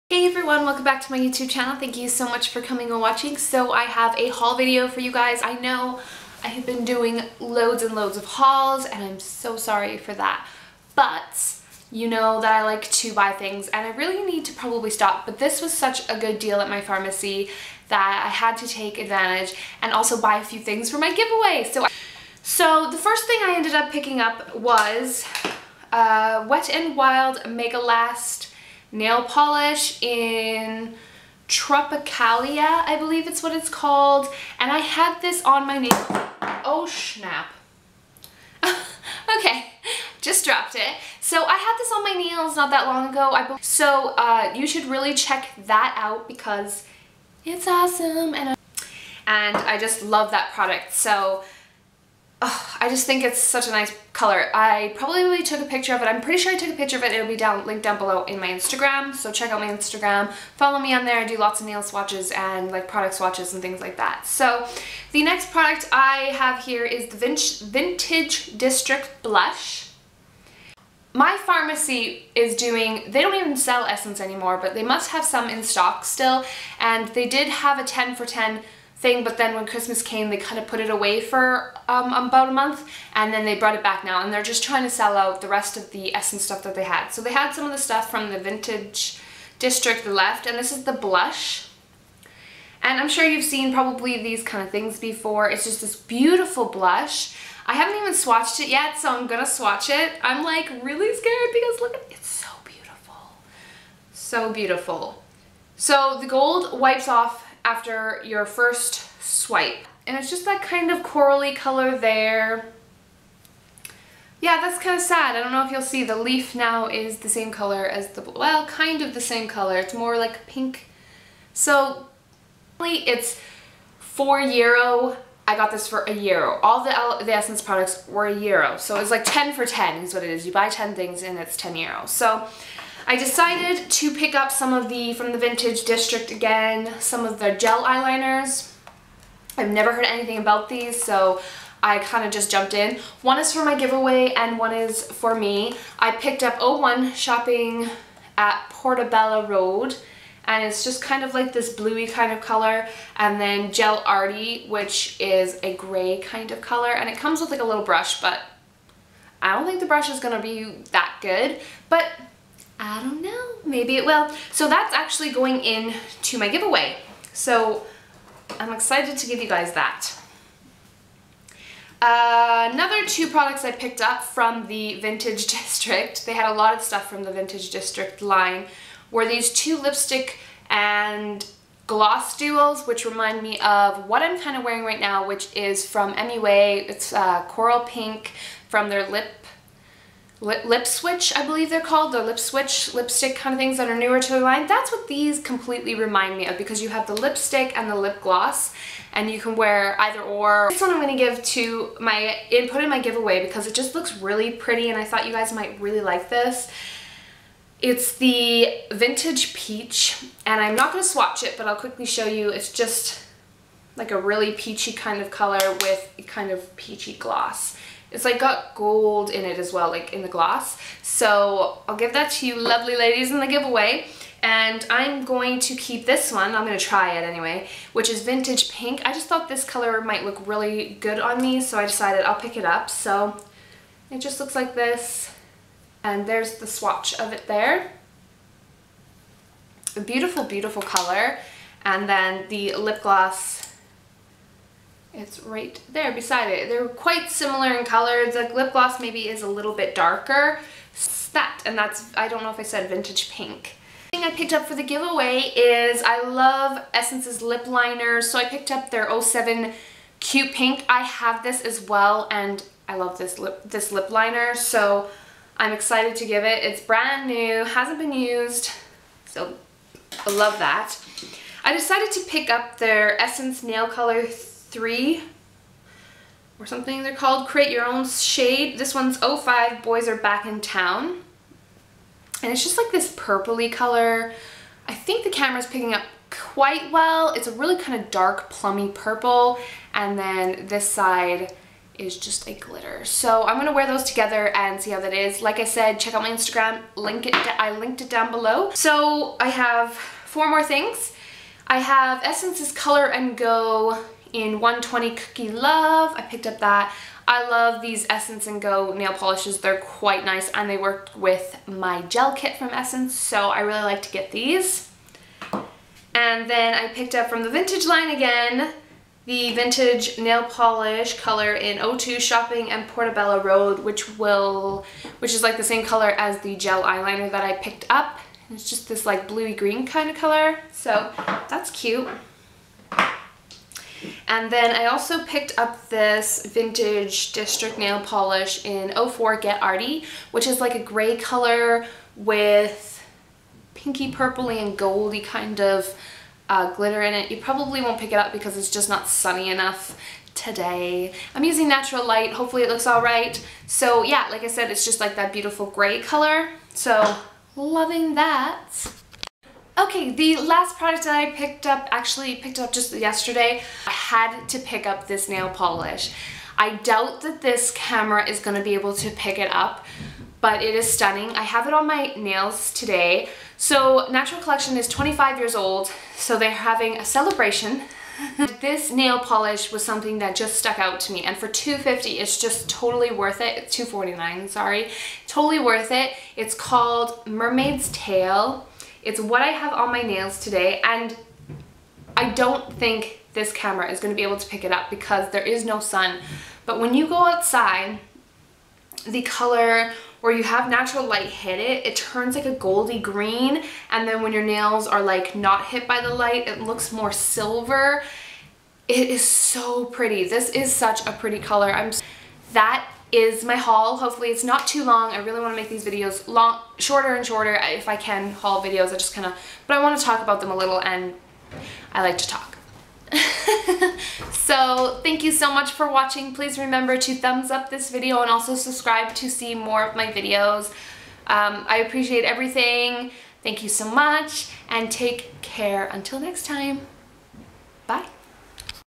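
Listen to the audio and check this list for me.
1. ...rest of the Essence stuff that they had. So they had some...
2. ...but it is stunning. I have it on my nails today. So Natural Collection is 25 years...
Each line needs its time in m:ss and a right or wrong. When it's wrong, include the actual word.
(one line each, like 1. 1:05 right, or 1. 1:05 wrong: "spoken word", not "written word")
1. 1:25 right
2. 6:10 right.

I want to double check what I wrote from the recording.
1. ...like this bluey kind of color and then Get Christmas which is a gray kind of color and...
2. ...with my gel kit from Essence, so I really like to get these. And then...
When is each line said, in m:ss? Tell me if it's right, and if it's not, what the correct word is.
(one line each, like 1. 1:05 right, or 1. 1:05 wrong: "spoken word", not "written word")
1. 2:31 wrong: "Arty", not "Christmas"
2. 5:11 right.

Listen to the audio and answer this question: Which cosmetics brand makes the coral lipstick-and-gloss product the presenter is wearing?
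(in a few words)
MUA.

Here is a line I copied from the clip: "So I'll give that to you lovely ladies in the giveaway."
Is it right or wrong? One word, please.
right.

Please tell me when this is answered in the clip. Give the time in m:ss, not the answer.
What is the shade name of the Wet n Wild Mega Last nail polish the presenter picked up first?
0:31.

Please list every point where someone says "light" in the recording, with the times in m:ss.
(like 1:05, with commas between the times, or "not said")
5:52, 6:41, 6:46.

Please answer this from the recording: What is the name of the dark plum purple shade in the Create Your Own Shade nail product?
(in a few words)
Boys Are Back in Town.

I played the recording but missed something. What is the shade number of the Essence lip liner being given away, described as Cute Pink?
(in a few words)
07.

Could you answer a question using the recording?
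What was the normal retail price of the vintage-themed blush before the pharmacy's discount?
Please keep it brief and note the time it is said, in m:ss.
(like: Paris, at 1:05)
4 euro, at 2:03.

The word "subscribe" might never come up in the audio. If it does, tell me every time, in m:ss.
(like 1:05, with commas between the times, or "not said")
7:08.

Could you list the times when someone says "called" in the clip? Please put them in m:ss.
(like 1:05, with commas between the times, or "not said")
0:33, 3:11, 4:37, 6:26.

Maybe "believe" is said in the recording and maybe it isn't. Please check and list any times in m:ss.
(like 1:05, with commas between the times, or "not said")
0:32, 3:11.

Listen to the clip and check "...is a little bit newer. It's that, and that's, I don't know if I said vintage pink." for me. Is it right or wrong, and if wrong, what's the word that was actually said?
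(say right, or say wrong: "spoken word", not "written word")
wrong: "darker", not "newer".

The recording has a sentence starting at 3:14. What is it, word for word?
That's what these completely remind me of because you have the lipstick and the lip gloss and you can wear either or.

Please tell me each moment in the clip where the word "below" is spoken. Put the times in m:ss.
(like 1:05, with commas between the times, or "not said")
0:57, 4:58.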